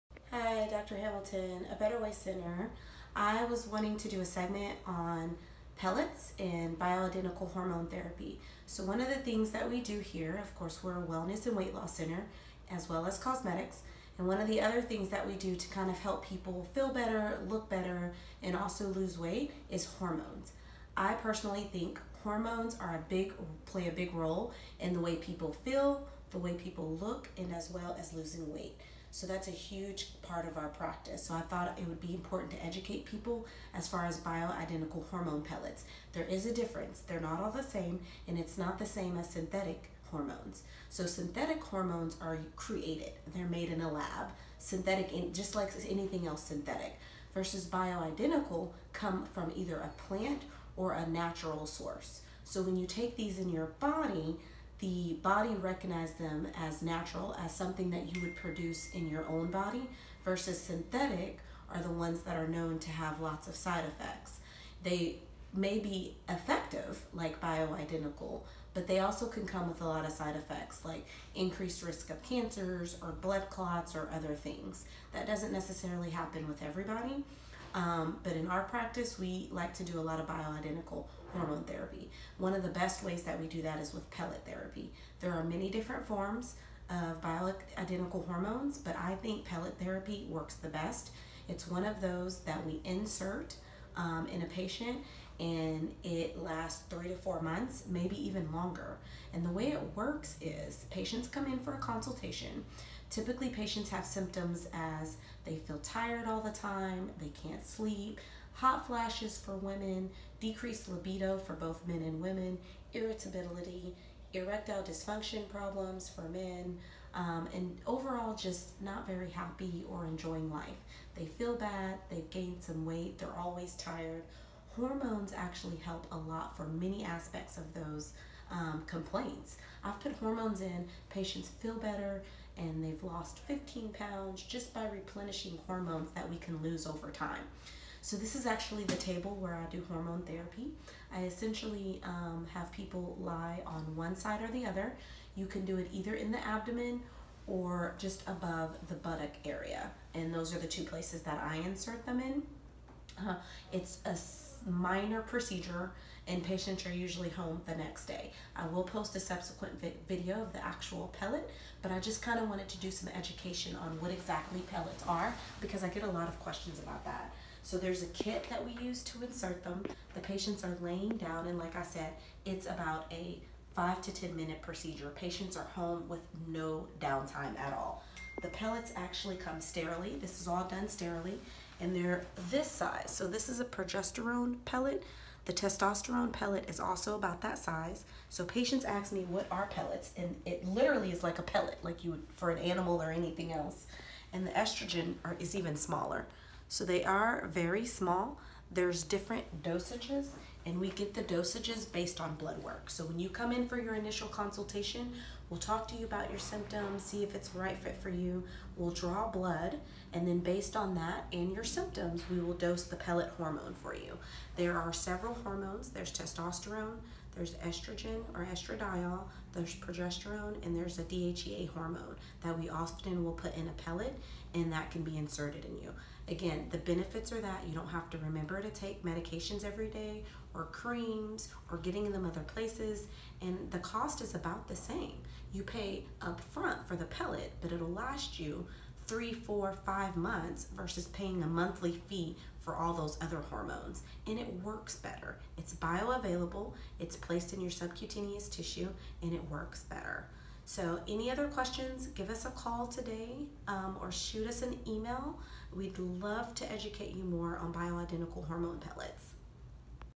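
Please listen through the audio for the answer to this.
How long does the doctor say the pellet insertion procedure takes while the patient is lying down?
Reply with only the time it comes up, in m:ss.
2:53.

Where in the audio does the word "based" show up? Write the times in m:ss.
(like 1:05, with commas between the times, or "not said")
3:21, 3:30.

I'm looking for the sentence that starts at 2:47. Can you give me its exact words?
So there's a kit that we use to insert them.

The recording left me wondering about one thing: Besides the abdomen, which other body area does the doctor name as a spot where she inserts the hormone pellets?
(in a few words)
Above the buttock.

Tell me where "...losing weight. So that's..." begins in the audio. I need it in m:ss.
0:28.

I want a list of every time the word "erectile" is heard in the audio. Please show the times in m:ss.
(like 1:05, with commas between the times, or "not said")
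1:54.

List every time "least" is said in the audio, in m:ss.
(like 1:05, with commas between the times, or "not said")
not said.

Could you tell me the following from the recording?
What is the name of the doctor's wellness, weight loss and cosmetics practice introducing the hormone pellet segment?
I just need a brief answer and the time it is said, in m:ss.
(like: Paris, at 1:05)
Better Weigh Center, at 0:01.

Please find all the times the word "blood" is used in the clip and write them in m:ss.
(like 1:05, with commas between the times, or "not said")
1:13, 3:22, 3:29.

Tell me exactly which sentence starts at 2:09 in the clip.
I've put hormones in, patients feel better, and they've lost 15 pounds just by replenishing hormones that we can lose over time.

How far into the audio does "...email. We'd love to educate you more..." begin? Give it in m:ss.
4:14.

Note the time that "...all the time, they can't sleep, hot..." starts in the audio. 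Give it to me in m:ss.
1:46.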